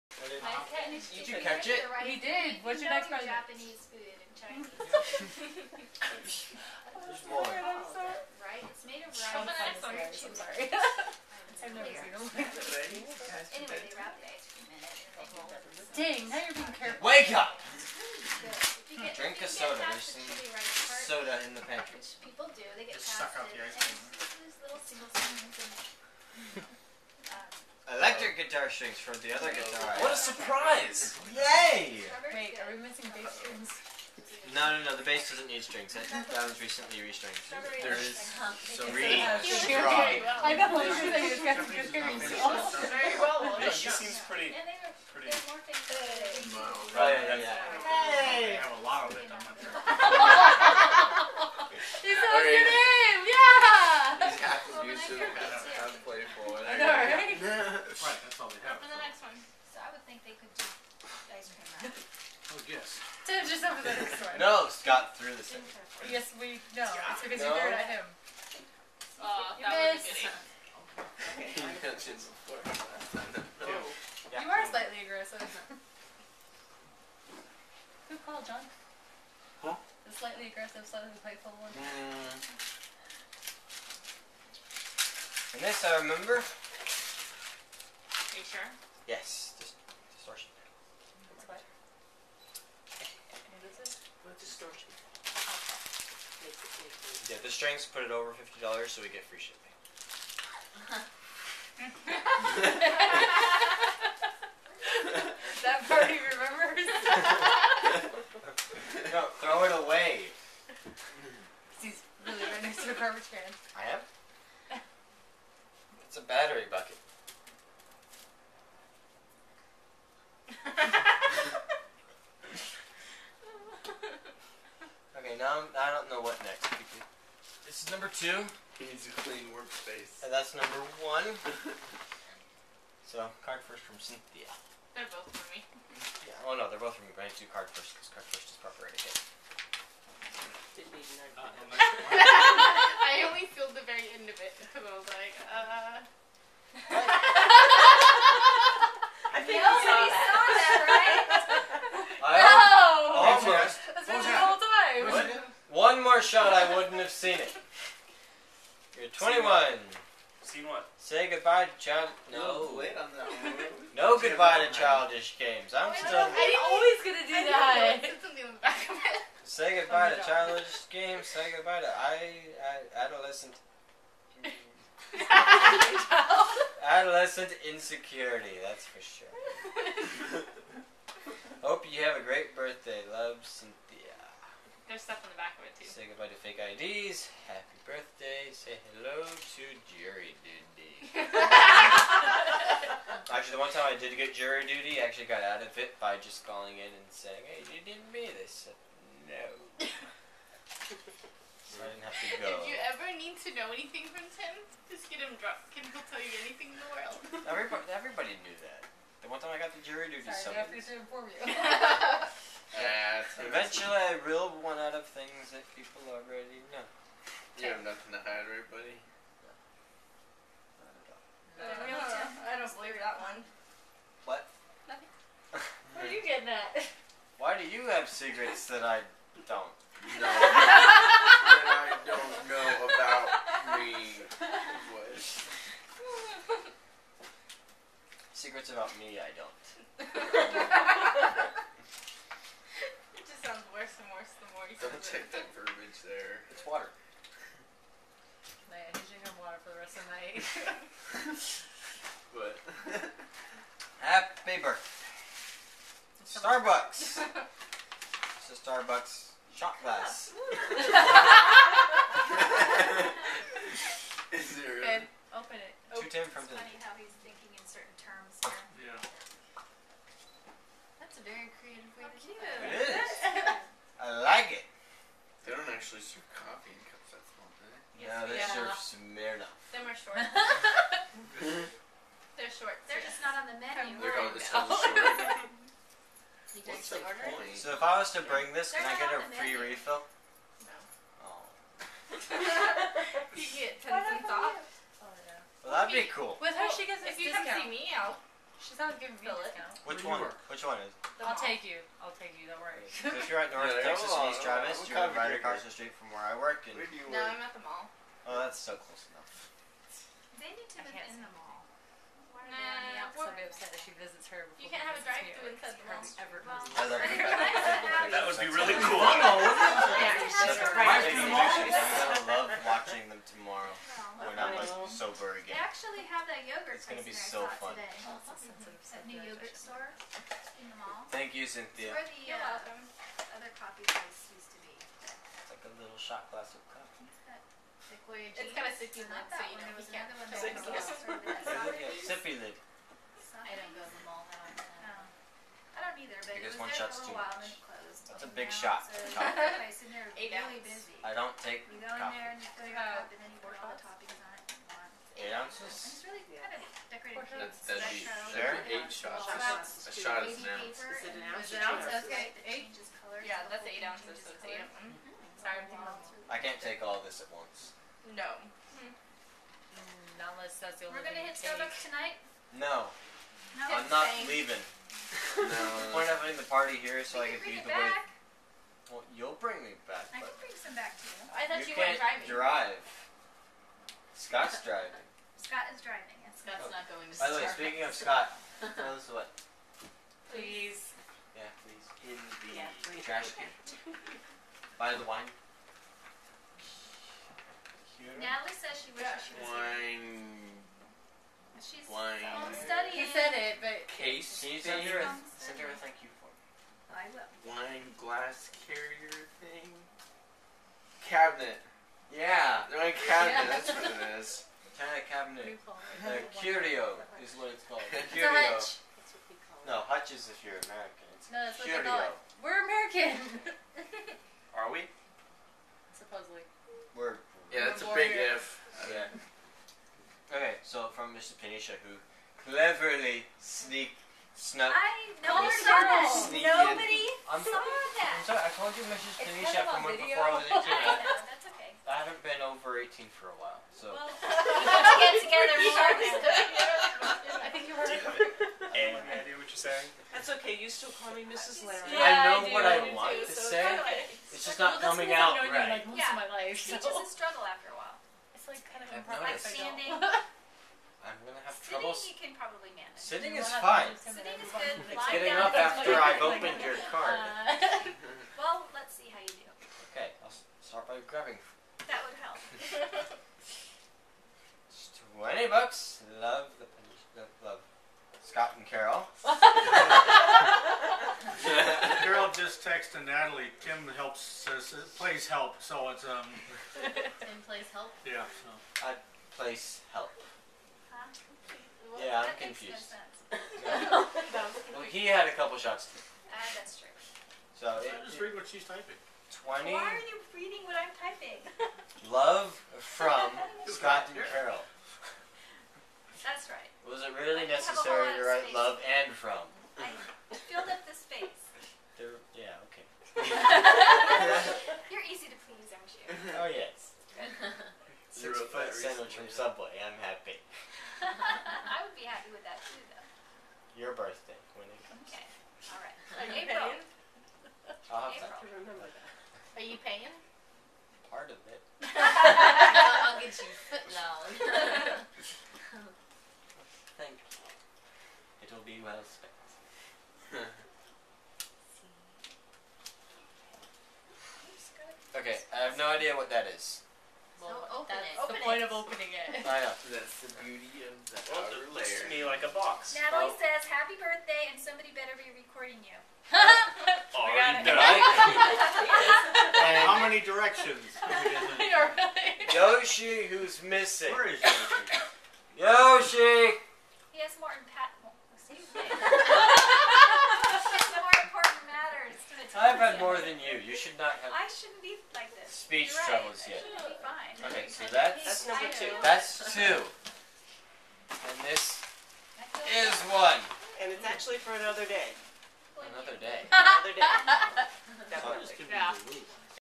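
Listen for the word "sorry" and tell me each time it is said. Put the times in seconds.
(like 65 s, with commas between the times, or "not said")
10 s, 210 s, 365 s, 438 s.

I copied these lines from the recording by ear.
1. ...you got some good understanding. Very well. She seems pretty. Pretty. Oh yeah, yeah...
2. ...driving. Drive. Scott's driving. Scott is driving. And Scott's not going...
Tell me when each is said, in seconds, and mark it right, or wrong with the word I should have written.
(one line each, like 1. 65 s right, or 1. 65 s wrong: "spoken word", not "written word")
1. 41 s wrong: "hearing", not "understanding"
2. 382 s right.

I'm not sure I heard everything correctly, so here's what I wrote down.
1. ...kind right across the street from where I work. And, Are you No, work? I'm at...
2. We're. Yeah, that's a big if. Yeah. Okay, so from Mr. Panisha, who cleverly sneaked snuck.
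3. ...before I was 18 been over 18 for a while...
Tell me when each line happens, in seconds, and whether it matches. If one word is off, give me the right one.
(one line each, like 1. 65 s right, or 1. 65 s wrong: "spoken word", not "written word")
1. 305 s wrong: "Where", not "Are"
2. 426 s right
3. 439 s right.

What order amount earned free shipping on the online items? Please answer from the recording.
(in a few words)
$50.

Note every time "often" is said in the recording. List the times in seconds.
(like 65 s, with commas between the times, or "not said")
344 s.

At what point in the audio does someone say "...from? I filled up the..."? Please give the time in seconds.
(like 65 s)
509 s.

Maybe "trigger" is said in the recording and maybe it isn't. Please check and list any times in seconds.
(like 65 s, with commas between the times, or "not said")
not said.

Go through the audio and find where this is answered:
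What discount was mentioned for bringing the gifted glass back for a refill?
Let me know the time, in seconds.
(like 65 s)
293 s.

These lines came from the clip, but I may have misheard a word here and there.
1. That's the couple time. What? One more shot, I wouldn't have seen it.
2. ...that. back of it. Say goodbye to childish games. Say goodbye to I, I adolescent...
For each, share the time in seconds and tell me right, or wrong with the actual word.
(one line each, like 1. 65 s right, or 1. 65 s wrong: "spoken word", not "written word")
1. 153 s wrong: "whole", not "couple"
2. 167 s right.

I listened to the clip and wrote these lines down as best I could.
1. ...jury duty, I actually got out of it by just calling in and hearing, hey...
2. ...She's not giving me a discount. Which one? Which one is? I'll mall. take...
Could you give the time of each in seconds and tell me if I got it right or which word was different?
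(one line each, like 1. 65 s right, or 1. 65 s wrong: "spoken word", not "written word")
1. 194 s wrong: "saying", not "hearing"
2. 298 s right.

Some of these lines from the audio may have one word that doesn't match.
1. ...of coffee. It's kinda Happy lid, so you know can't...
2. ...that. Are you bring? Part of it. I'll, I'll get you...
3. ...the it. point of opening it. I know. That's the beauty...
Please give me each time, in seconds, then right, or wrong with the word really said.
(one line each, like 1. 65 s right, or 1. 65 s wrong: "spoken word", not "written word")
1. 336 s wrong: "sippy", not "Happy"
2. 528 s wrong: "paying", not "bring"
3. 548 s right.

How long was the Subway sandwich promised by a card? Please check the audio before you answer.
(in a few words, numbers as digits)
6 foot.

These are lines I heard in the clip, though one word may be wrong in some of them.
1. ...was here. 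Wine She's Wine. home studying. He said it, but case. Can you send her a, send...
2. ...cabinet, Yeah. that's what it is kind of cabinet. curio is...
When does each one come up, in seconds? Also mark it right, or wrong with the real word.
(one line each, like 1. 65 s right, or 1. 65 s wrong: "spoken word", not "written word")
1. 399 s right
2. 413 s right.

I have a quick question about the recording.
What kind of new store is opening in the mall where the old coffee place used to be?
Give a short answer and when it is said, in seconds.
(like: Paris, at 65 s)
yogurt store, at 329 s.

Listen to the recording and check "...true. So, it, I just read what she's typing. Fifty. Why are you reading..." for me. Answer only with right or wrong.
wrong.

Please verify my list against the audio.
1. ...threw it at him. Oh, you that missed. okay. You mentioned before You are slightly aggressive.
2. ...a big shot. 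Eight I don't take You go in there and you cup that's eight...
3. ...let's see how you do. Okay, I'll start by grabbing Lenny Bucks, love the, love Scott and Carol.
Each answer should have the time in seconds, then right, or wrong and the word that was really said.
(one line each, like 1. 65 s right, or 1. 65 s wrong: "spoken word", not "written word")
1. 67 s right
2. 348 s right
3. 468 s right.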